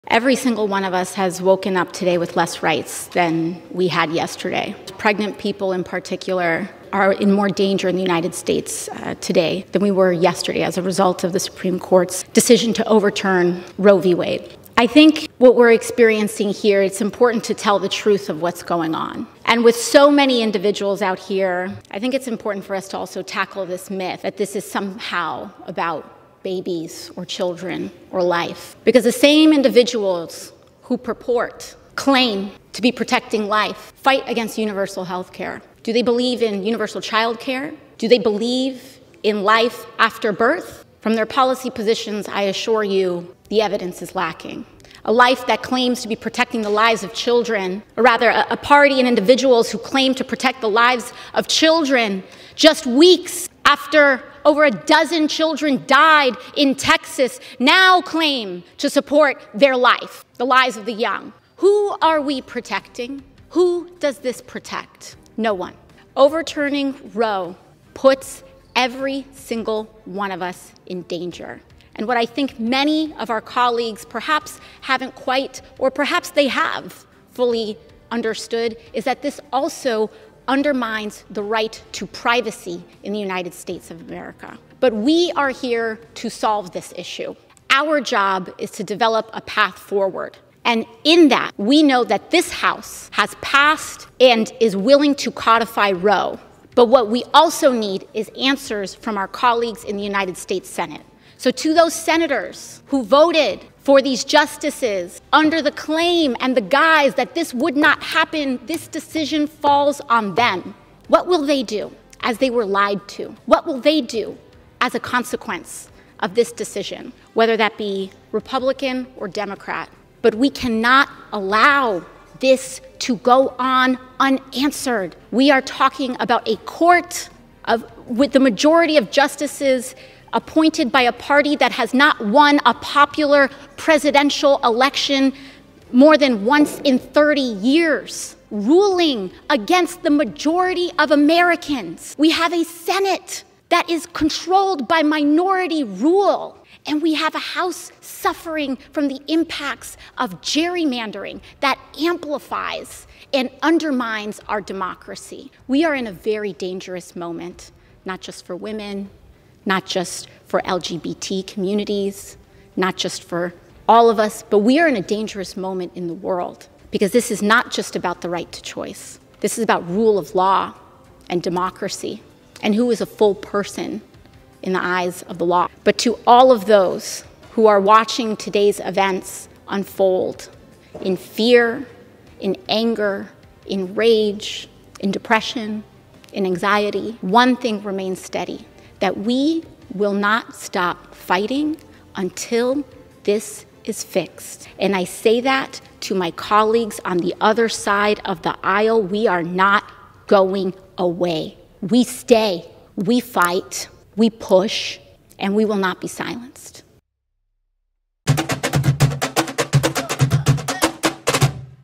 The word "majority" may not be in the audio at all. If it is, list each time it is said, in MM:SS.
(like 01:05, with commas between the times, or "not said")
02:08, 02:20.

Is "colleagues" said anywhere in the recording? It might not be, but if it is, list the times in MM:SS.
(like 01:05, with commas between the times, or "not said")
01:13, 01:39, 03:16.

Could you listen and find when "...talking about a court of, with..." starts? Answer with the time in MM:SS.
02:05.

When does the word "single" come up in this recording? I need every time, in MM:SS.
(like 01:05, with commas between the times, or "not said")
00:00, 01:09.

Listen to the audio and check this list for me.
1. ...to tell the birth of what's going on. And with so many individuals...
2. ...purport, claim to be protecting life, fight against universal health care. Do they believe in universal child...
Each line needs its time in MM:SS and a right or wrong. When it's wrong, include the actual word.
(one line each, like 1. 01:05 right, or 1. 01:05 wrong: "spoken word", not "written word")
1. 00:17 wrong: "truth", not "birth"
2. 00:30 right.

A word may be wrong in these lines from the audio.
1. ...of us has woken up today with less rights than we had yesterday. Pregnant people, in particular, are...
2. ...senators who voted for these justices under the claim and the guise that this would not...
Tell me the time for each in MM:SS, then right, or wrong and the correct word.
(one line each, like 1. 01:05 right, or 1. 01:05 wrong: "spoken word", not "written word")
1. 00:00 right
2. 01:41 right.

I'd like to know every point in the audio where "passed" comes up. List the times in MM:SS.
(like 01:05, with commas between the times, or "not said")
01:33.